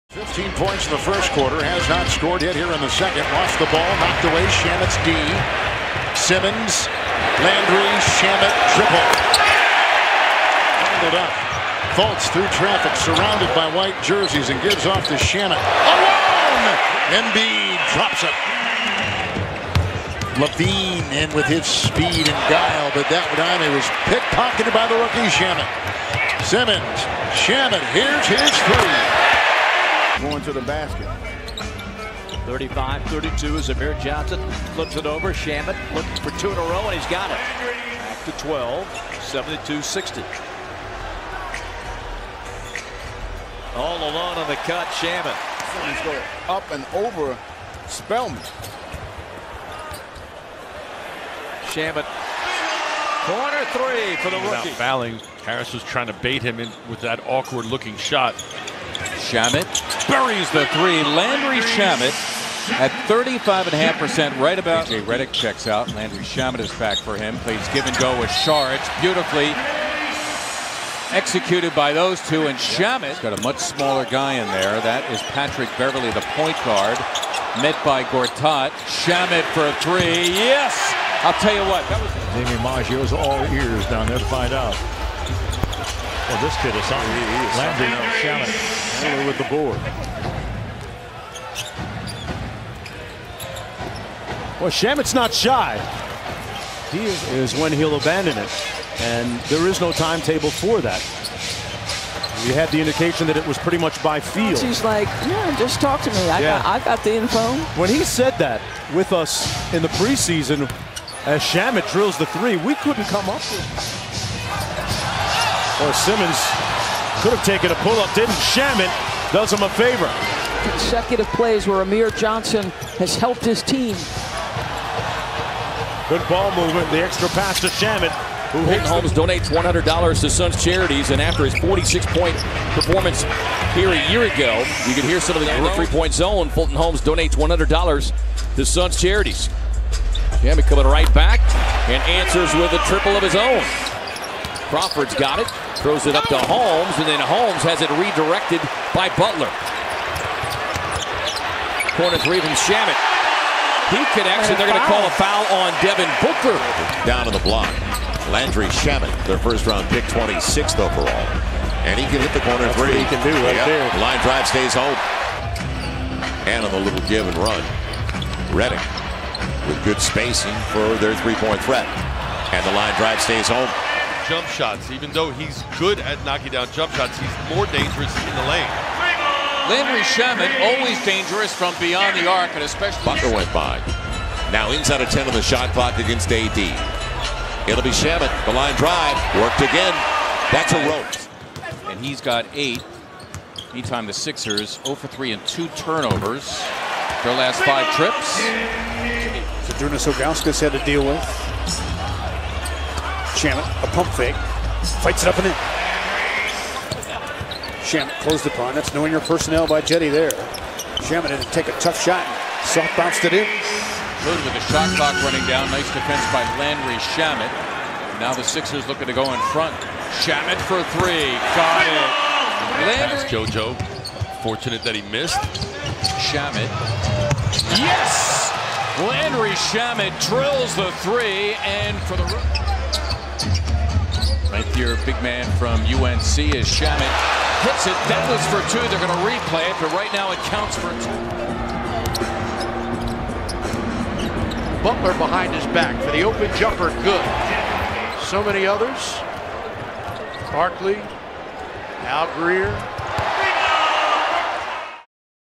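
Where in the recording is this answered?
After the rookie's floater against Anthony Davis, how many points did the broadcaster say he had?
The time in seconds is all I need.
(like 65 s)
192 s.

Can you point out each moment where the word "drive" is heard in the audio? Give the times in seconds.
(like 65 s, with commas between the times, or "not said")
164 s, 172 s, 188 s.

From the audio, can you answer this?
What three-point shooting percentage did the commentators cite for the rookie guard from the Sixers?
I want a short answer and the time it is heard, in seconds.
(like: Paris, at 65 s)
35.5%, at 63 s.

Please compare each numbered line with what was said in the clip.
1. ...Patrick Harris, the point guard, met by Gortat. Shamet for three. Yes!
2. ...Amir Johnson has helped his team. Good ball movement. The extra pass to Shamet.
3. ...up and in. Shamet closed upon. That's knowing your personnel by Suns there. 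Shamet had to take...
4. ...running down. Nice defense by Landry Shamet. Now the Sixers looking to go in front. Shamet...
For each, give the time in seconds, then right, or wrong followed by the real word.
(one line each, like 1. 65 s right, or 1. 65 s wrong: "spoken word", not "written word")
1. 75 s wrong: "Beverley", not "Harris"
2. 121 s right
3. 205 s wrong: "Jetty", not "Suns"
4. 215 s right.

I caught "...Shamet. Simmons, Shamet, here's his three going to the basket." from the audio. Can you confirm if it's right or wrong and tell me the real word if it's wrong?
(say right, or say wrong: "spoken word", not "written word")
right.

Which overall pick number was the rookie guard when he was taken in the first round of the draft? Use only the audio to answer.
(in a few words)
26th.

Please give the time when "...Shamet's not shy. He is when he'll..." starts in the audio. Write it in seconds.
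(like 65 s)
94 s.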